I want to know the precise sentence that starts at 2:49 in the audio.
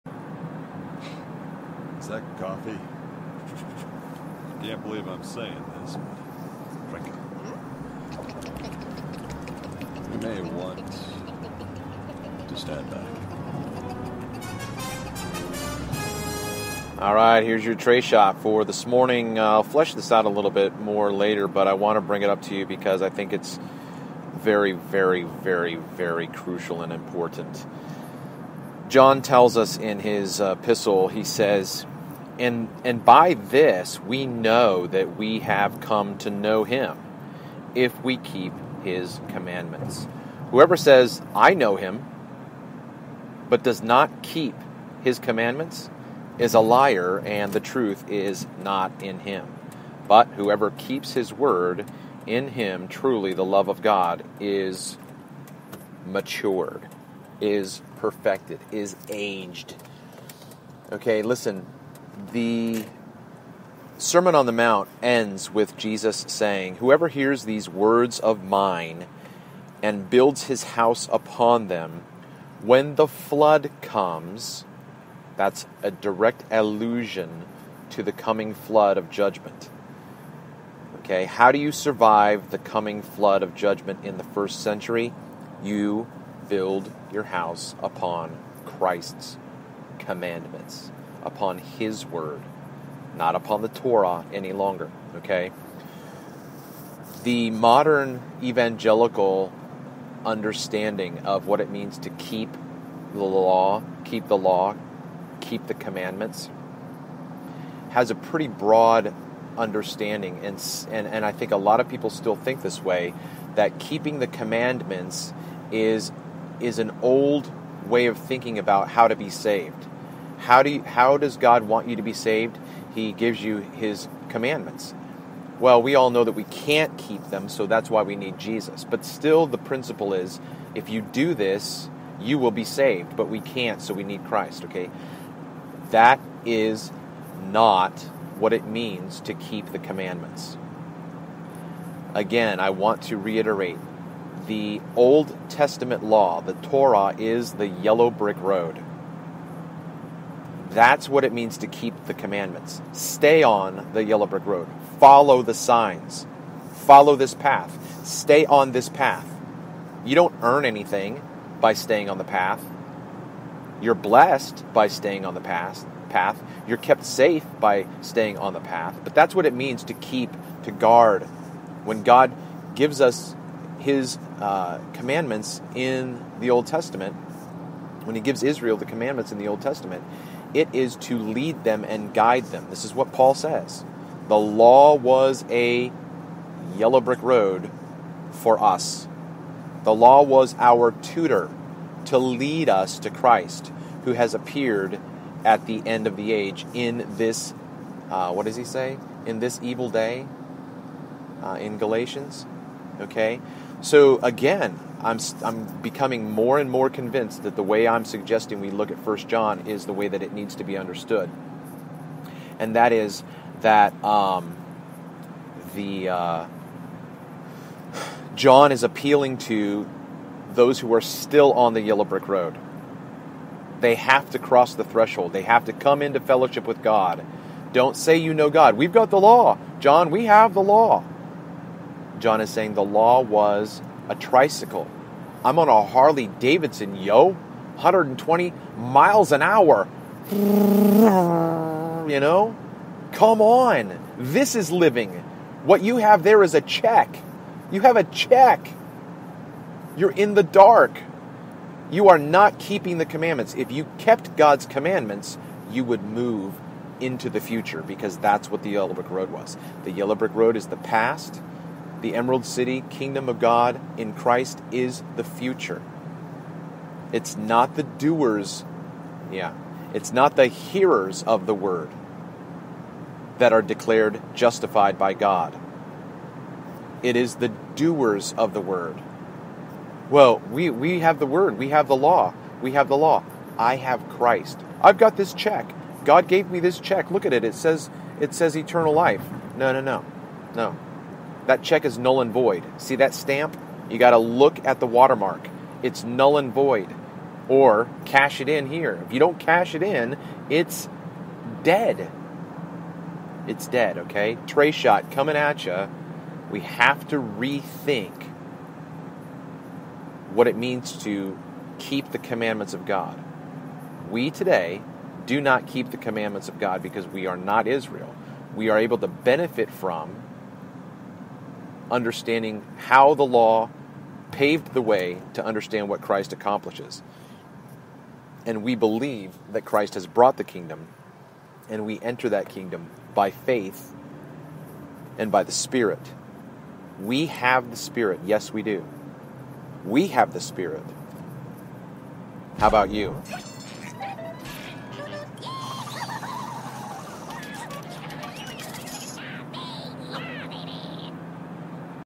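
But that's what it means to keep, to guard.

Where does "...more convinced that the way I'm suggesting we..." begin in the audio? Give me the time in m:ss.
3:26.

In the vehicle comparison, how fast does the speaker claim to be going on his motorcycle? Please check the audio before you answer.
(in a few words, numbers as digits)
120 miles an hour.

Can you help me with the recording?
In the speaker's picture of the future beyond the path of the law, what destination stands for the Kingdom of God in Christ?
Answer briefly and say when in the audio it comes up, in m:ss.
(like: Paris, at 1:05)
Emerald City, at 4:22.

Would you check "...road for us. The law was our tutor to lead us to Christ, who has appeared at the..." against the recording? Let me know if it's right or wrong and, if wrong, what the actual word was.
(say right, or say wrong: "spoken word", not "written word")
right.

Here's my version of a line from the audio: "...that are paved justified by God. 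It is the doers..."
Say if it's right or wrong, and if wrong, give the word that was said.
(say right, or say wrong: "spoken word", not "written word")
wrong: "declared", not "paved".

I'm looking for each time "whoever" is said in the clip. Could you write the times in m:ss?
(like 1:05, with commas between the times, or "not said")
0:40, 0:50, 1:06.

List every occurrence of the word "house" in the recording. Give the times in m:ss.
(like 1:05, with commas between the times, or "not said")
1:10, 1:27.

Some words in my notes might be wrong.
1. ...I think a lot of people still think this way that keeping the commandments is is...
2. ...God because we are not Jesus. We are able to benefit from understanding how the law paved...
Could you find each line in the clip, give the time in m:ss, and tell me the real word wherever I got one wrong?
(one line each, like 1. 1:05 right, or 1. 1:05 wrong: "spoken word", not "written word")
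1. 1:51 right
2. 5:16 wrong: "Israel", not "Jesus".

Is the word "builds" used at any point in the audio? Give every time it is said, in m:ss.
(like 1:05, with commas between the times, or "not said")
1:10, 1:26.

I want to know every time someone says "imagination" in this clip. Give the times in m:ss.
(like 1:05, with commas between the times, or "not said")
not said.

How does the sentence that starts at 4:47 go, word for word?
It says it says eternal life.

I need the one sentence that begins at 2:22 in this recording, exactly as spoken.
Again, I want to reiterate the Old Testament law, the Torah, is the yellow brick road.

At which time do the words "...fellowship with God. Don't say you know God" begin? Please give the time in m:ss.
3:46.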